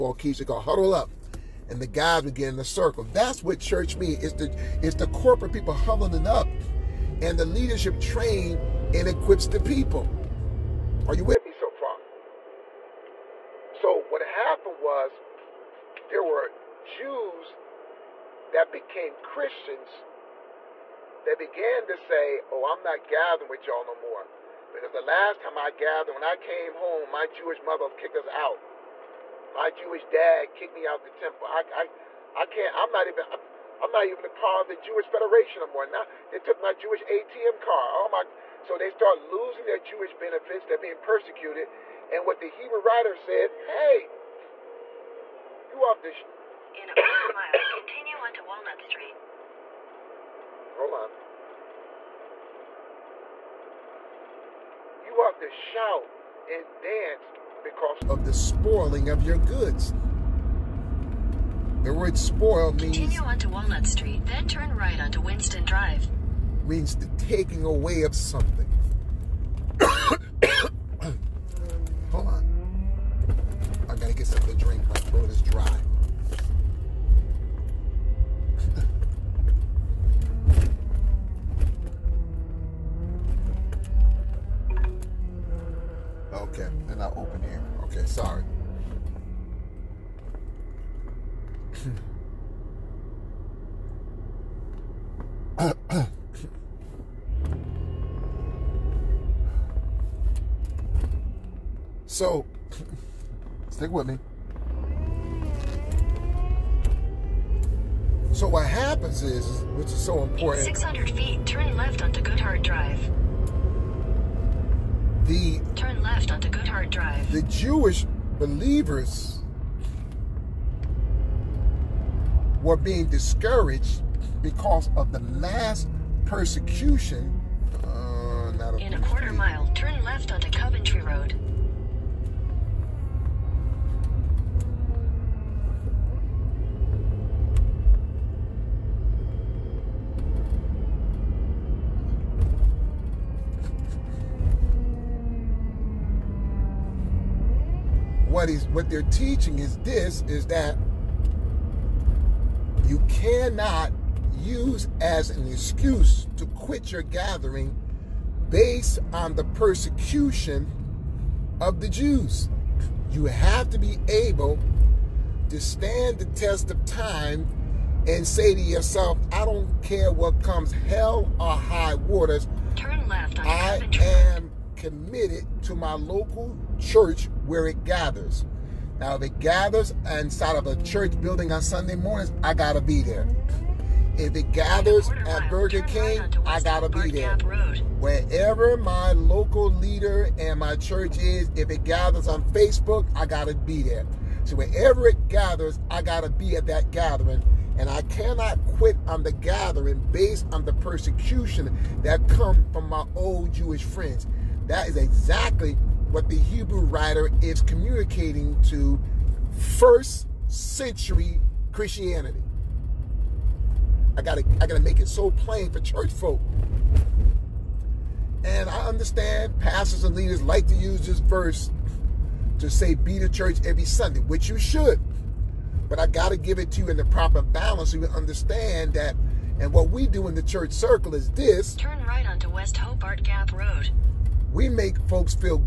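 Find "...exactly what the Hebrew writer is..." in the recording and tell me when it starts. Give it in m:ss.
3:24.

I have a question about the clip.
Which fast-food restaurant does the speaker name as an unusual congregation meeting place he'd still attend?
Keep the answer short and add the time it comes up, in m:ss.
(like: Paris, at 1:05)
Burger King, at 3:05.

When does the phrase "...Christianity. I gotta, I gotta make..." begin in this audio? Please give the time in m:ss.
3:31.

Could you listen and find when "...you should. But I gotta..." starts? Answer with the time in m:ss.
3:44.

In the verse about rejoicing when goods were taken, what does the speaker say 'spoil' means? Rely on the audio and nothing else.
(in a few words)
taking away of something.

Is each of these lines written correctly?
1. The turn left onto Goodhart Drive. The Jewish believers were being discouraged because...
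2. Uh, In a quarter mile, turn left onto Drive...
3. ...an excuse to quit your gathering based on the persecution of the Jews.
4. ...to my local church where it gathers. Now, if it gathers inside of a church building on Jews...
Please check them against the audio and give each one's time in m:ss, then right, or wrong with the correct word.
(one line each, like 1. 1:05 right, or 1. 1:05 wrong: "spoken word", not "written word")
1. 1:55 right
2. 2:07 wrong: "Coventry", not "Drive"
3. 2:35 right
4. 2:55 wrong: "Sunday", not "Jews".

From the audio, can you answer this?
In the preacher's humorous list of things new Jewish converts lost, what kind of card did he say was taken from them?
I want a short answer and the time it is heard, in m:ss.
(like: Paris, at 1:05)
Jewish ATM card, at 0:36.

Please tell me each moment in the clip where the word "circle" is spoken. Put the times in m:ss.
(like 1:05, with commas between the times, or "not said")
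0:02, 3:50.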